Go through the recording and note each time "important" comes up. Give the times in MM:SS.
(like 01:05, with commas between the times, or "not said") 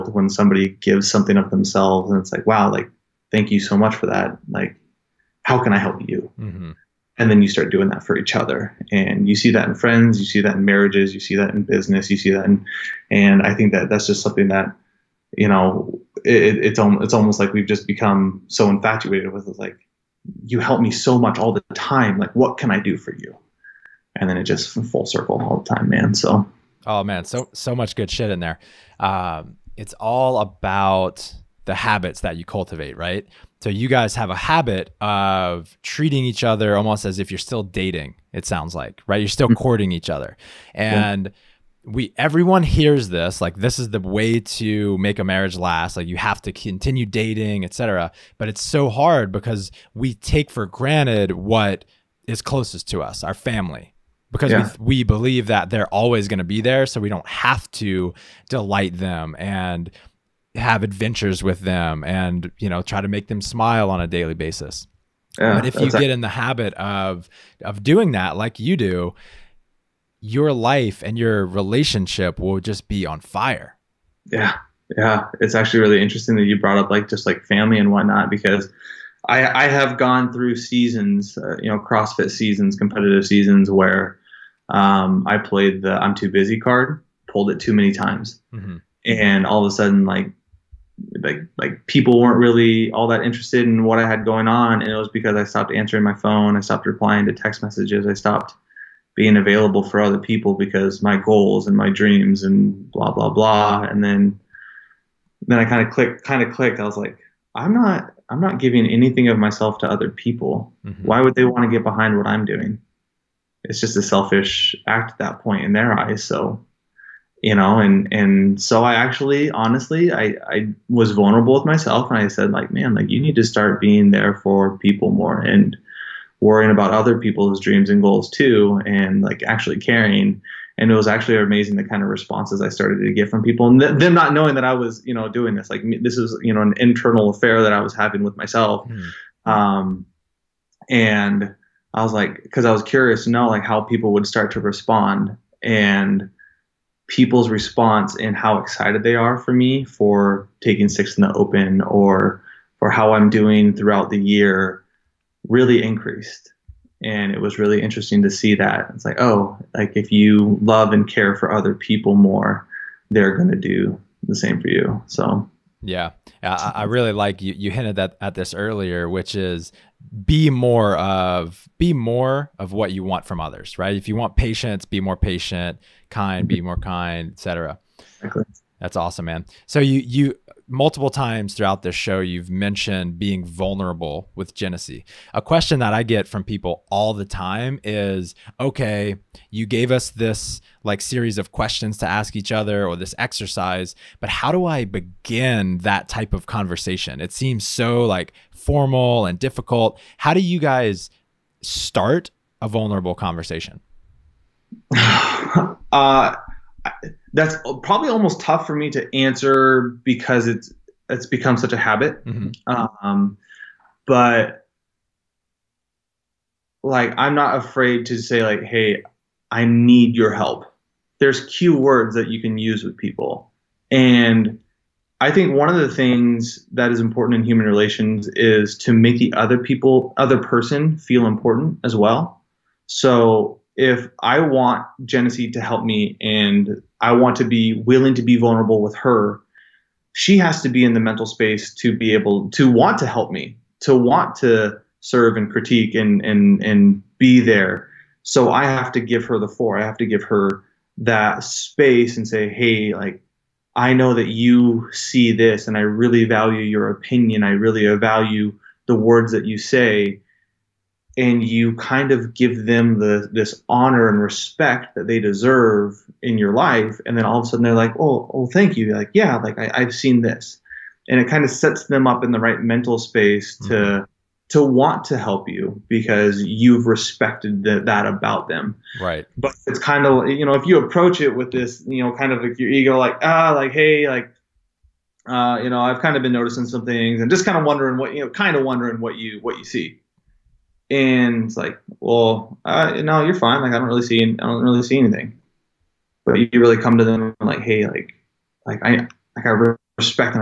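03:46, 03:51.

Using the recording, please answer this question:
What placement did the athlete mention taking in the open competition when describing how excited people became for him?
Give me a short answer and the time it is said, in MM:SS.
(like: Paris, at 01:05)
6, at 02:30.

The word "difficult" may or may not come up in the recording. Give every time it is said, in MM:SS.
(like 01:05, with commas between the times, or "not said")
03:19.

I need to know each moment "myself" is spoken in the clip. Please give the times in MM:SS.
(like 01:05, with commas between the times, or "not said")
01:49, 02:01, 02:18.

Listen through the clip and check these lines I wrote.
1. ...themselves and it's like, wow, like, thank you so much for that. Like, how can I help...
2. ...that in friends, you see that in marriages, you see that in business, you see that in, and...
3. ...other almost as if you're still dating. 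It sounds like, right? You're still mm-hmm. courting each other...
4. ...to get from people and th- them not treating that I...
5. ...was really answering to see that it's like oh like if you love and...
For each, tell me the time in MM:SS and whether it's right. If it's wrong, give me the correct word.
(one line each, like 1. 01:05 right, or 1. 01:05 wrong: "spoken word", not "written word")
1. 00:01 right
2. 00:09 right
3. 00:36 right
4. 02:13 wrong: "knowing", not "treating"
5. 02:37 wrong: "interesting", not "answering".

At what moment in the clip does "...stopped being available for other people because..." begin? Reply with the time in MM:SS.
01:38.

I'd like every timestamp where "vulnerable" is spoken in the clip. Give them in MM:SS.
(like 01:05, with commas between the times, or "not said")
02:01, 03:03, 03:22, 03:58.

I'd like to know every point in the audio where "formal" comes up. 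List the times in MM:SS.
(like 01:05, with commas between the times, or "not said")
03:18.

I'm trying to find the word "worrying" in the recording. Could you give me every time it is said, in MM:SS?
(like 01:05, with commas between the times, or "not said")
02:06.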